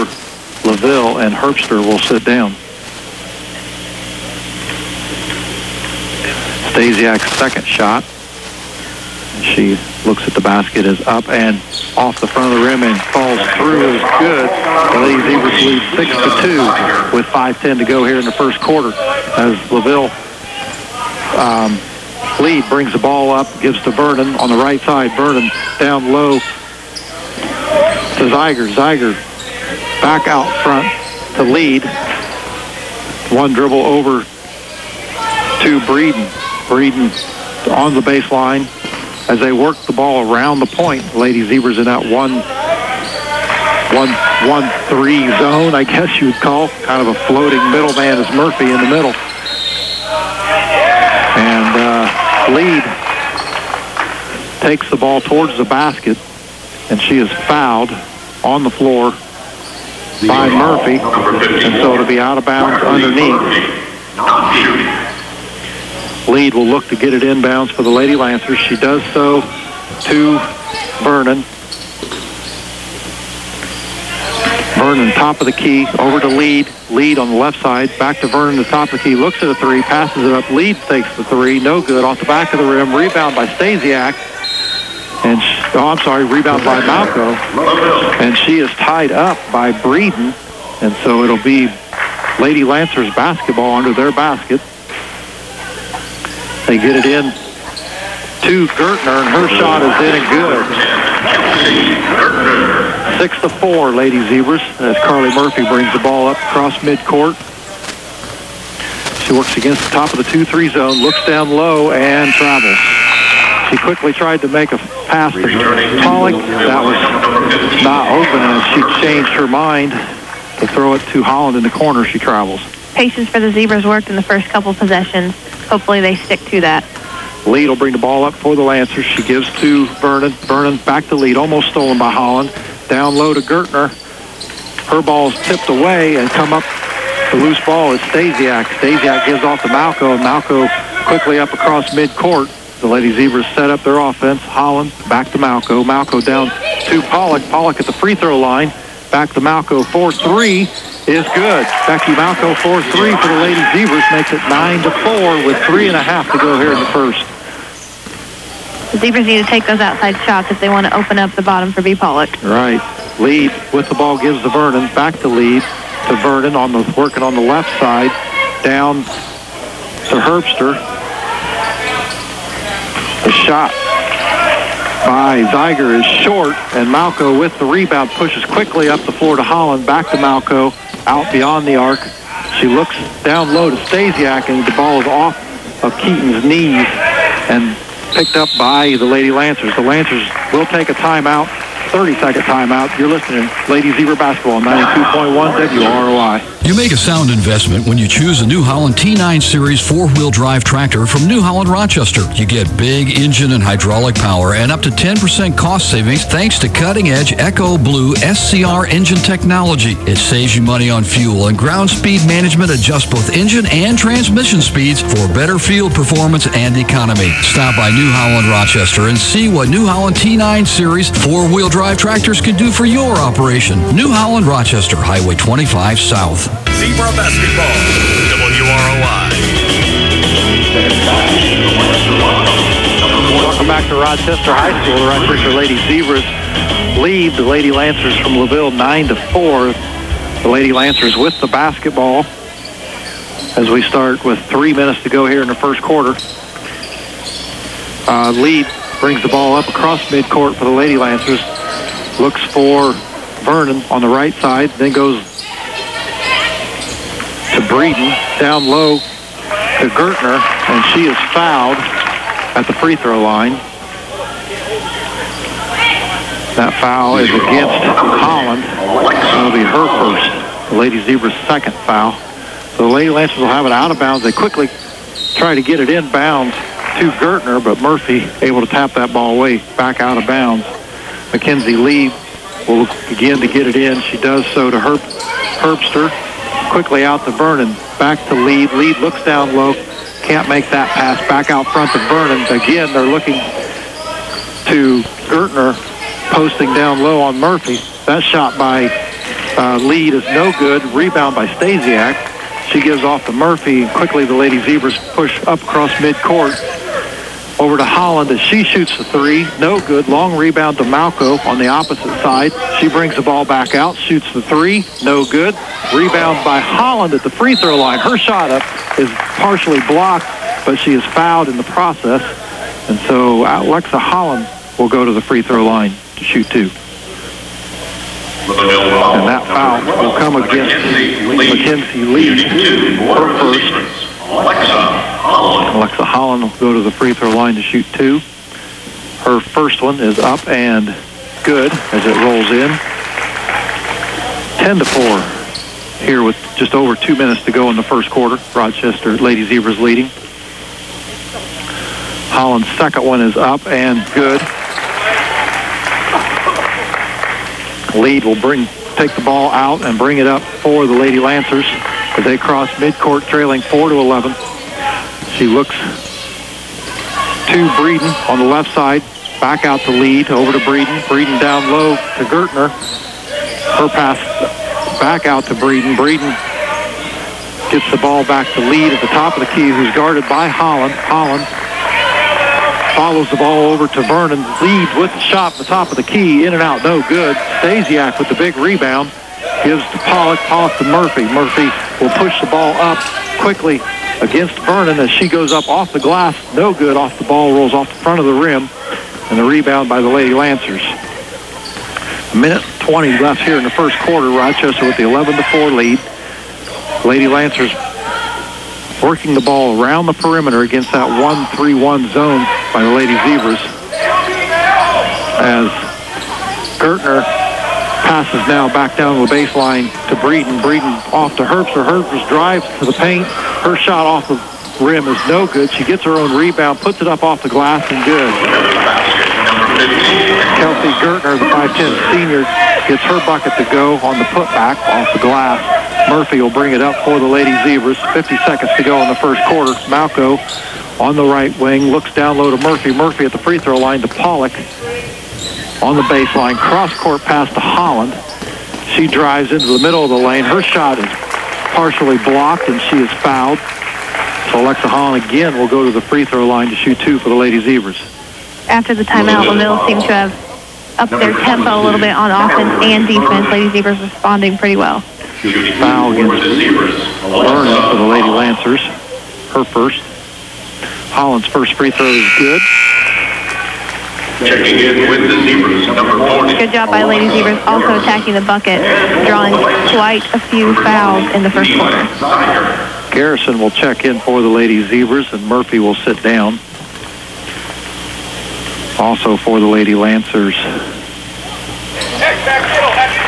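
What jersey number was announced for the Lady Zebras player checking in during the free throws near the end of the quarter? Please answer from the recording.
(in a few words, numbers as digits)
40.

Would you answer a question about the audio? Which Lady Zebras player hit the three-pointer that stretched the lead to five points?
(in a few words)
Becky Malco.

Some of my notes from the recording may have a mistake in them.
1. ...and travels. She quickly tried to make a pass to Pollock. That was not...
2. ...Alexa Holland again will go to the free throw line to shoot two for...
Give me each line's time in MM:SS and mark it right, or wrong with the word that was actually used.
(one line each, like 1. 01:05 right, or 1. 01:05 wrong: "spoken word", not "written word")
1. 01:51 right
2. 07:34 right.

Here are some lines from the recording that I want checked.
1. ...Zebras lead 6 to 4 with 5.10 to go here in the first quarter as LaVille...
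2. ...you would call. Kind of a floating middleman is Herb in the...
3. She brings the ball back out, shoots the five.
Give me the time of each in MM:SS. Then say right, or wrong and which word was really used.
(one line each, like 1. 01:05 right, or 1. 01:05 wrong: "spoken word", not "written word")
1. 00:15 wrong: "2", not "4"
2. 00:46 wrong: "Murphy", not "Herb"
3. 05:12 wrong: "three", not "five".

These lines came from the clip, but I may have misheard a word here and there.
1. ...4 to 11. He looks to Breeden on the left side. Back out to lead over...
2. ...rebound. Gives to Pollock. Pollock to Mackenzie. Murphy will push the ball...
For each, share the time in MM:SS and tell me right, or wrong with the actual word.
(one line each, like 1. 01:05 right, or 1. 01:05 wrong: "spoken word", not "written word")
1. 06:03 right
2. 06:28 wrong: "Murphy", not "Mackenzie".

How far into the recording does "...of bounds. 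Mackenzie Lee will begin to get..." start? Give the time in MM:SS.
04:40.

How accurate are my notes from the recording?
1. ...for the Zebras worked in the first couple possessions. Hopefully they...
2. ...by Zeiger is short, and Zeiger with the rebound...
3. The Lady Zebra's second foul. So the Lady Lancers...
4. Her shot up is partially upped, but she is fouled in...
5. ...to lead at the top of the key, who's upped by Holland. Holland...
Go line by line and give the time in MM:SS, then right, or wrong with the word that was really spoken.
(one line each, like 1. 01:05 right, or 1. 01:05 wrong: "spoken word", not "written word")
1. 02:03 right
2. 02:55 wrong: "Malco", not "Zeiger"
3. 04:30 right
4. 05:17 wrong: "blocked", not "upped"
5. 06:18 wrong: "guarded", not "upped".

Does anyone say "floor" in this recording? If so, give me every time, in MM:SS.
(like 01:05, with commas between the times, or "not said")
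00:58, 02:59.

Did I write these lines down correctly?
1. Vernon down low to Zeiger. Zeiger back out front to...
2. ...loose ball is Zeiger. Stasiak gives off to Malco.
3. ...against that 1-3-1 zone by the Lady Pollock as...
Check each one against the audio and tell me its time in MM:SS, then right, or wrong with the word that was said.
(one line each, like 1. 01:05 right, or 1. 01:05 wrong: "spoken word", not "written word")
1. 00:25 right
2. 02:17 wrong: "Stasiak", not "Zeiger"
3. 06:50 wrong: "Zebras", not "Pollock".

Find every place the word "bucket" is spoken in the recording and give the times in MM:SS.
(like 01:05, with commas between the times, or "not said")
07:13, 07:58.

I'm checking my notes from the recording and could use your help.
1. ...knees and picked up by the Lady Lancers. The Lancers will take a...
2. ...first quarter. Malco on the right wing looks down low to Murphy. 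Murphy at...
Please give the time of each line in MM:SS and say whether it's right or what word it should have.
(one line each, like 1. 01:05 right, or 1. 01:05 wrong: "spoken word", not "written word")
1. 03:06 right
2. 07:19 right.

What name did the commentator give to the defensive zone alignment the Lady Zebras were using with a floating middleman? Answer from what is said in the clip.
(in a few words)
1-1-1-3 zone.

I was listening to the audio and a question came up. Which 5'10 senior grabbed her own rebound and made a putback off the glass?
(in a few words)
Kelsey Gertner.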